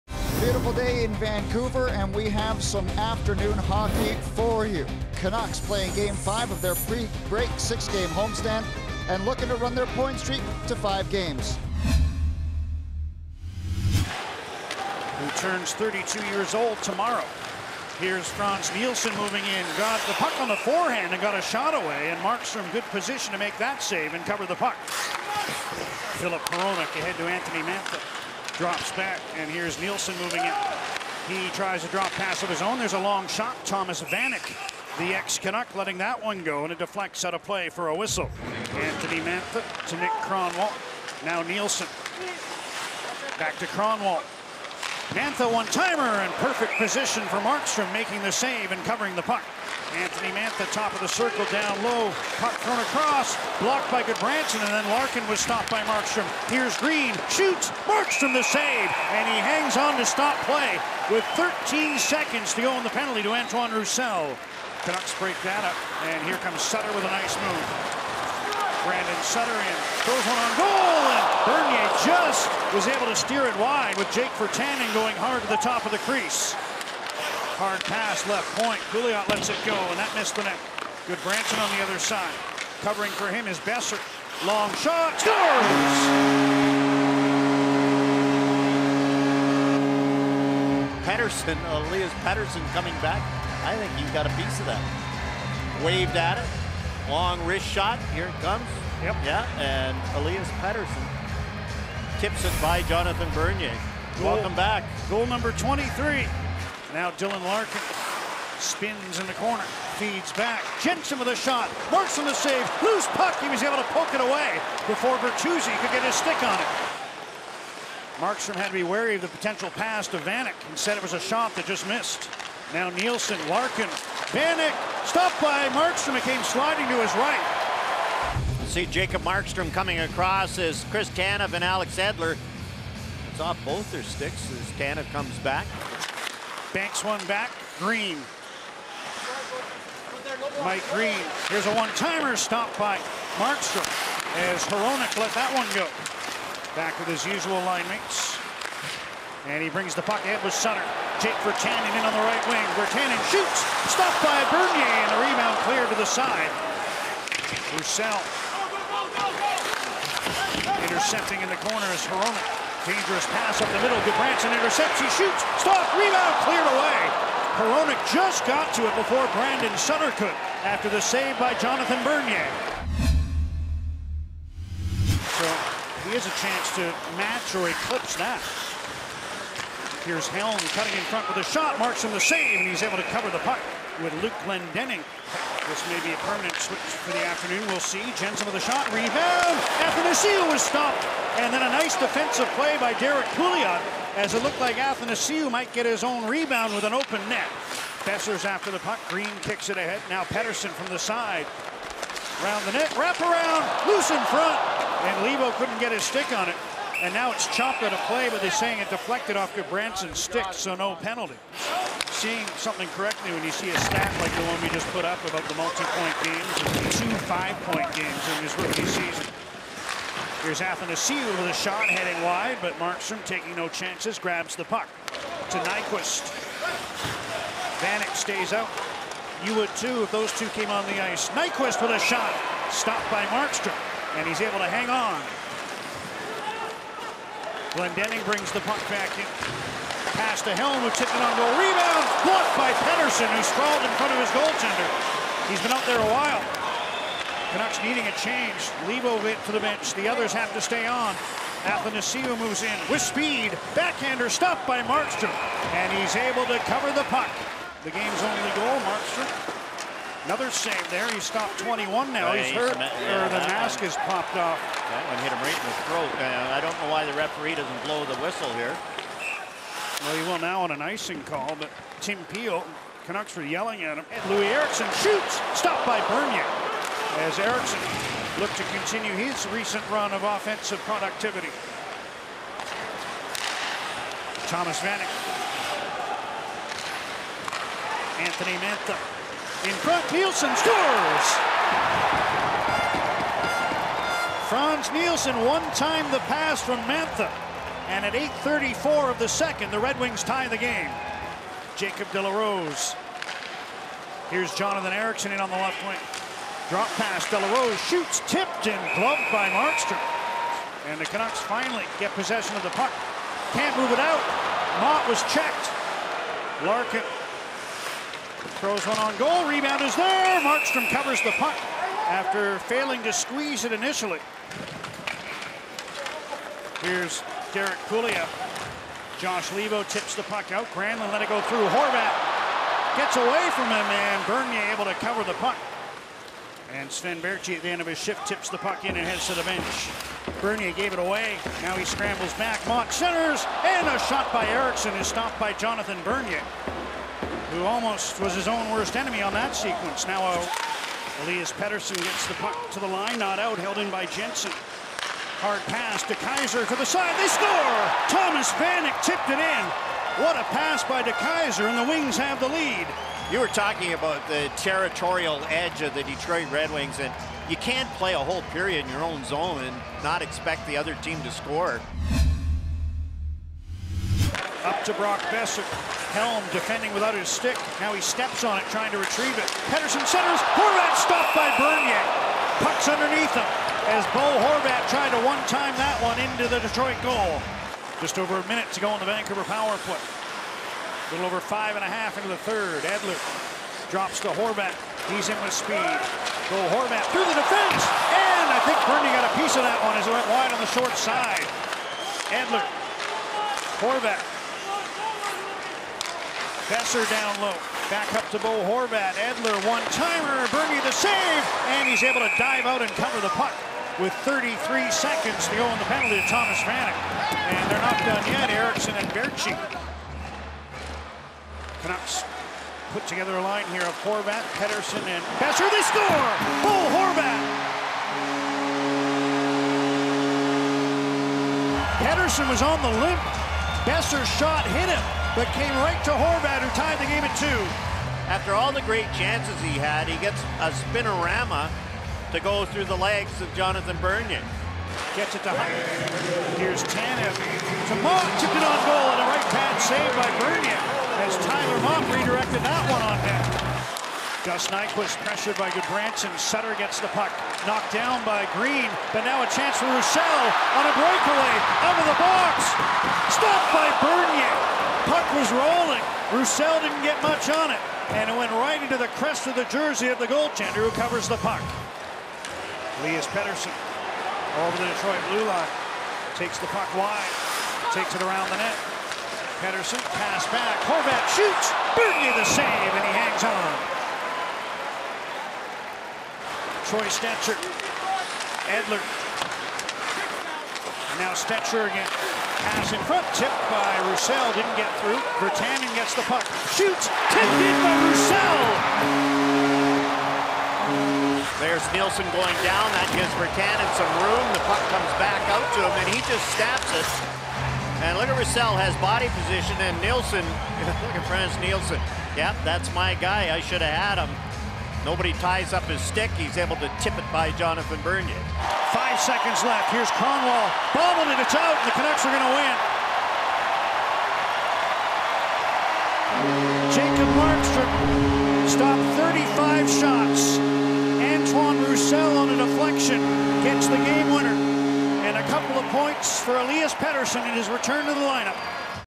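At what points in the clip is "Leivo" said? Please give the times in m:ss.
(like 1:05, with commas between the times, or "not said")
3:25, 5:29.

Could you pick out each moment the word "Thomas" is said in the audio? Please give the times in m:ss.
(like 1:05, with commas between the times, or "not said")
0:33, 4:44, 5:58, 6:56.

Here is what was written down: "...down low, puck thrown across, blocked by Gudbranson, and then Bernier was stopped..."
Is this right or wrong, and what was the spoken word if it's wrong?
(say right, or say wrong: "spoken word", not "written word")
wrong: "Larkin", not "Bernier".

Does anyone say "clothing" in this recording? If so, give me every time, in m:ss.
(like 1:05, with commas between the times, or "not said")
not said.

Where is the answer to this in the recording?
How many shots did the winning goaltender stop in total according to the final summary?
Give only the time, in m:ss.
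8:48.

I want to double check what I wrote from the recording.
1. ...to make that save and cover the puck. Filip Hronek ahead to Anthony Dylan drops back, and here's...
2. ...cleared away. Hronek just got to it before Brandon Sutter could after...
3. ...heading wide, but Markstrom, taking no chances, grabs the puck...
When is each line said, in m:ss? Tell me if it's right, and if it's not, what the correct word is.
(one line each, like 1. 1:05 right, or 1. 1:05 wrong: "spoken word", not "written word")
1. 0:23 wrong: "Mantha", not "Dylan"
2. 2:46 right
3. 3:41 right.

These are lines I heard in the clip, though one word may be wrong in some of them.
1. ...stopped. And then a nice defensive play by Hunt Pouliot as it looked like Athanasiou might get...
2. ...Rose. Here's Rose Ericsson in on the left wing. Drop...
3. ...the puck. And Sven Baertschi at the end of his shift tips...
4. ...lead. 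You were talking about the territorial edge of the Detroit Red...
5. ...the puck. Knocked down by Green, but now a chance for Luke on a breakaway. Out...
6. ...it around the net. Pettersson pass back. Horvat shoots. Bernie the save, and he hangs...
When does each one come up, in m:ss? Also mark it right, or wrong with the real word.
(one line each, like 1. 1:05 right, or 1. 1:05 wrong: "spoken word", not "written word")
1. 3:10 wrong: "Derek", not "Hunt"
2. 5:02 wrong: "Jonathan", not "Rose"
3. 5:35 right
4. 6:02 right
5. 7:36 wrong: "Roussel", not "Luke"
6. 7:58 right.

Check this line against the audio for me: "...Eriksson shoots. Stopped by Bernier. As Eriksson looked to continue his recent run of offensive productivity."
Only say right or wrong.
right.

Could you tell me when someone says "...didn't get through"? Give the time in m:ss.
8:14.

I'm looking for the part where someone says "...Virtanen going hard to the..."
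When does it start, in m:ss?
1:14.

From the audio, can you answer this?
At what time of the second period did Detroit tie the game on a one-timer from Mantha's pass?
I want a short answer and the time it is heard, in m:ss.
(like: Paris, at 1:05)
8:34, at 4:58.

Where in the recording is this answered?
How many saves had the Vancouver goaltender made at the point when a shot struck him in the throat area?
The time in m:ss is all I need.
4:21.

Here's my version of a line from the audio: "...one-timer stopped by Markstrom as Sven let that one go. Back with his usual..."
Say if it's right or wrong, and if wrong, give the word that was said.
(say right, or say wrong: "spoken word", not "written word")
wrong: "Hronek", not "Sven".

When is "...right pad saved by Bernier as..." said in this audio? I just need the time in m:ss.
7:29.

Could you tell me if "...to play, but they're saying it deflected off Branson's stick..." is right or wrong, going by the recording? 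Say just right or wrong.
right.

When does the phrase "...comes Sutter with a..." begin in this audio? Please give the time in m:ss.
1:06.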